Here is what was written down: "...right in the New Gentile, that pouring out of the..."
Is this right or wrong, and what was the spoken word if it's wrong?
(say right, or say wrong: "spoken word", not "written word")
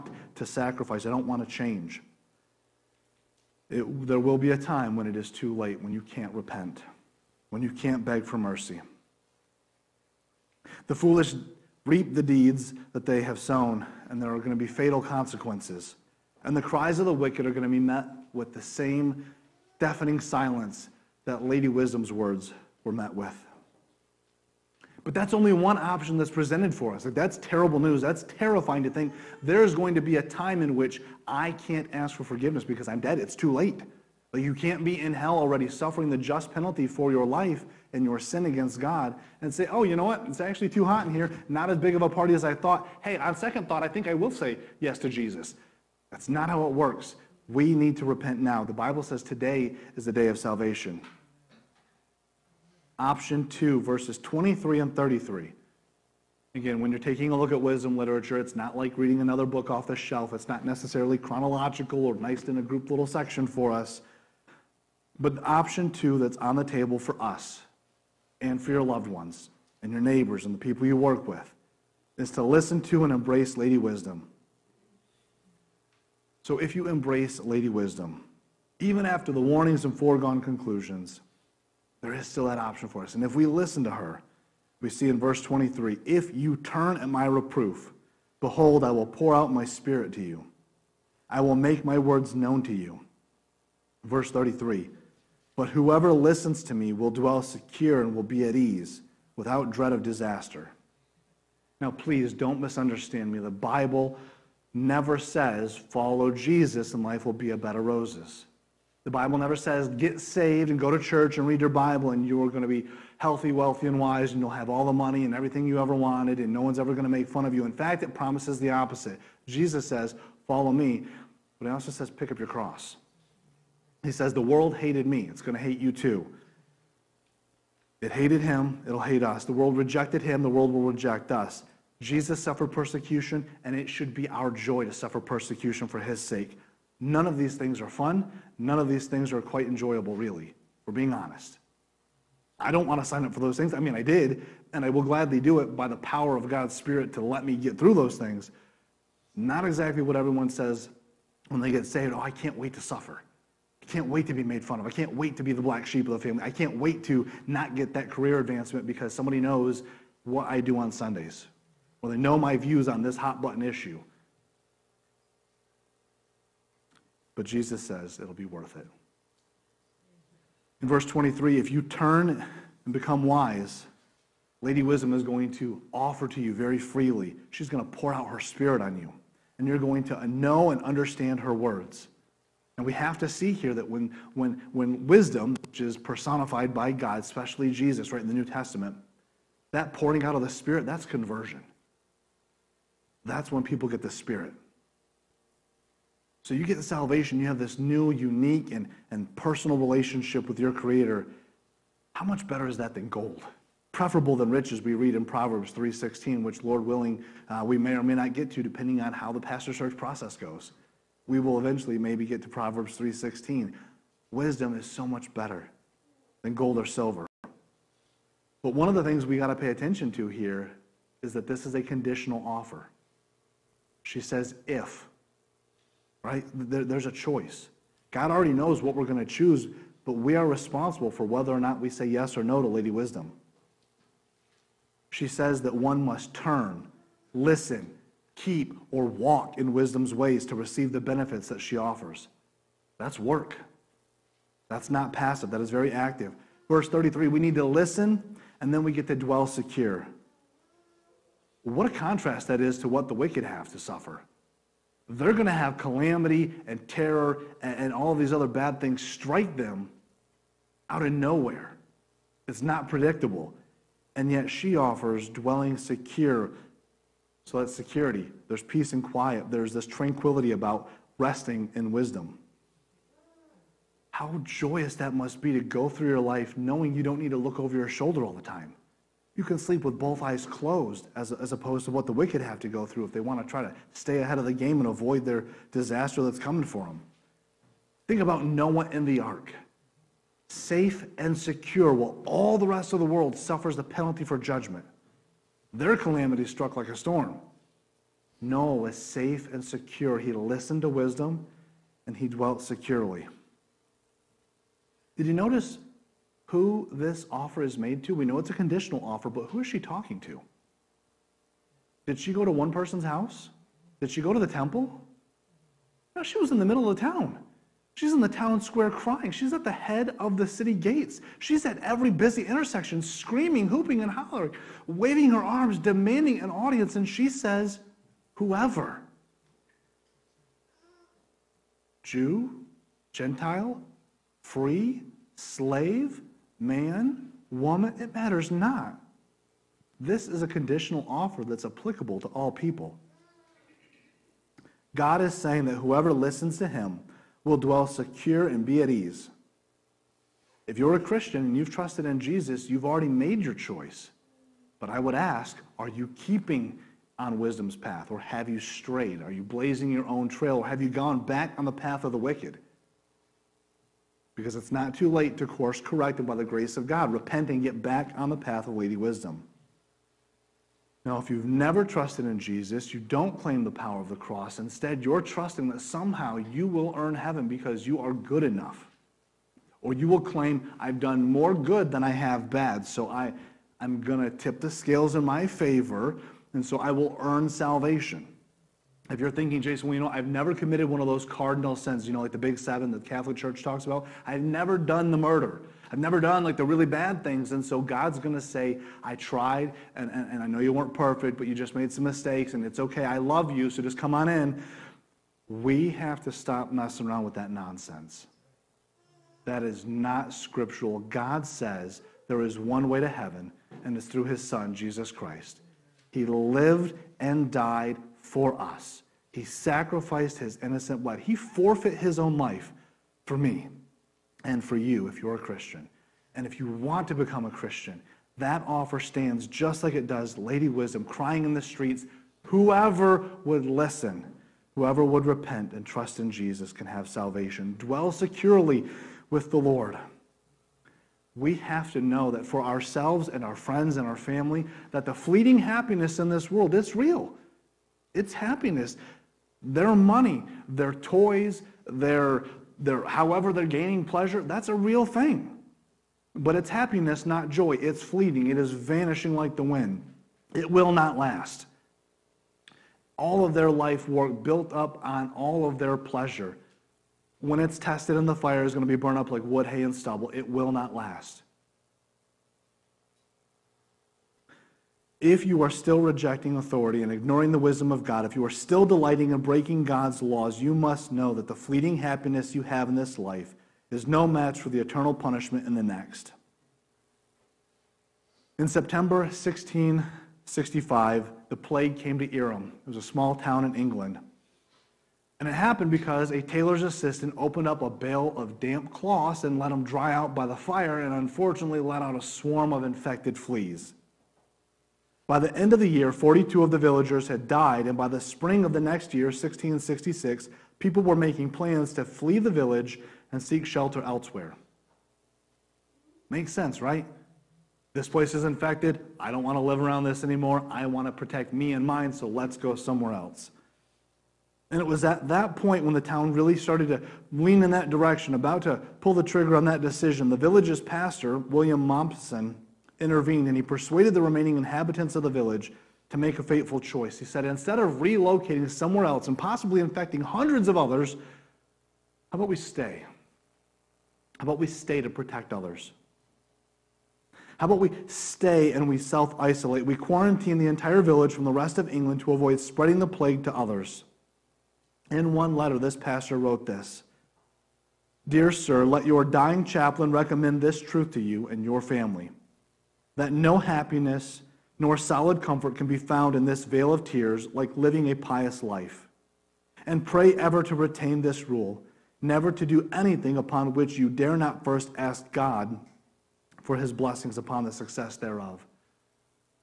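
wrong: "Testament", not "Gentile".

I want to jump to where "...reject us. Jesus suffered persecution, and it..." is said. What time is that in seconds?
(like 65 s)
130 s.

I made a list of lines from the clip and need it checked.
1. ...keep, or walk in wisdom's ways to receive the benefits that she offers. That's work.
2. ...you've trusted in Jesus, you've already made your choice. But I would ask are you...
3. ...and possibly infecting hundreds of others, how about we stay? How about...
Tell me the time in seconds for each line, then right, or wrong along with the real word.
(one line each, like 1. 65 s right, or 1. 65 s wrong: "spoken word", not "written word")
1. 238 s right
2. 351 s right
3. 539 s right.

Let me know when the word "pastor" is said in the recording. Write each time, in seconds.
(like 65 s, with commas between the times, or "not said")
209 s, 530 s, 555 s.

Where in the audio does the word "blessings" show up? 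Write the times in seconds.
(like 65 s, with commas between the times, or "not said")
576 s.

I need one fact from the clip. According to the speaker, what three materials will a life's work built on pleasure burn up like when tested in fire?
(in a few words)
wood, hay, and stubble.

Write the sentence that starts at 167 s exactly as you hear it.
But Jesus says it'll be worth it.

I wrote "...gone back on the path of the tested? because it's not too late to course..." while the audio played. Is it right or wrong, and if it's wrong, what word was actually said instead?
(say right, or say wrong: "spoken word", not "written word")
wrong: "wicked", not "tested".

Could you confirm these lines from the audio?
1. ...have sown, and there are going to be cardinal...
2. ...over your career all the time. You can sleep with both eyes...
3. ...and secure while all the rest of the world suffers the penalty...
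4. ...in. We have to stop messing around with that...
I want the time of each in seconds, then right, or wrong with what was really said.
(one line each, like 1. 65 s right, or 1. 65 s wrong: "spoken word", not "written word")
1. 13 s wrong: "fatal", not "cardinal"
2. 277 s wrong: "shoulder", not "career"
3. 291 s right
4. 404 s right.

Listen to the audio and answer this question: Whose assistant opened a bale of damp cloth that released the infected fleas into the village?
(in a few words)
a tailor's.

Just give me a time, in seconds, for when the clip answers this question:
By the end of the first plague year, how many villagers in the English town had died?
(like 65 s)
506 s.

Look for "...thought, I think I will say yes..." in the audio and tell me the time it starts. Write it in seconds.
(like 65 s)
43 s.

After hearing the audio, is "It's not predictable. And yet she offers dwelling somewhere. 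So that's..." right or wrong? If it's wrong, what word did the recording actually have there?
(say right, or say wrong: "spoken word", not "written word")
wrong: "secure", not "somewhere".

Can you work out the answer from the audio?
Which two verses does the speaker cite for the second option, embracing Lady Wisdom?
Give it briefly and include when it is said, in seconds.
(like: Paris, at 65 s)
23 and 33, at 53 s.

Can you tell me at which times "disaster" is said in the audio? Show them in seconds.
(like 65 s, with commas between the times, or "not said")
100 s, 285 s.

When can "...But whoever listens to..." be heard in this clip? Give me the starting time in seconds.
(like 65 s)
95 s.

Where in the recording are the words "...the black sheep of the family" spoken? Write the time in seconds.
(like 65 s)
155 s.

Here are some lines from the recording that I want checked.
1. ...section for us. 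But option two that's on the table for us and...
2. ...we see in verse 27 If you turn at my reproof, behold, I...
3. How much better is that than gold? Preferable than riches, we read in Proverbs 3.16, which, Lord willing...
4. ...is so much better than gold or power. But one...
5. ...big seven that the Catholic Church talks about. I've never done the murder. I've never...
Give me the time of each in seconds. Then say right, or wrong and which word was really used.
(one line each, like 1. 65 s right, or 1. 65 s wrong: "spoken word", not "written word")
1. 63 s right
2. 84 s wrong: "23", not "27"
3. 202 s right
4. 214 s wrong: "silver", not "power"
5. 392 s right.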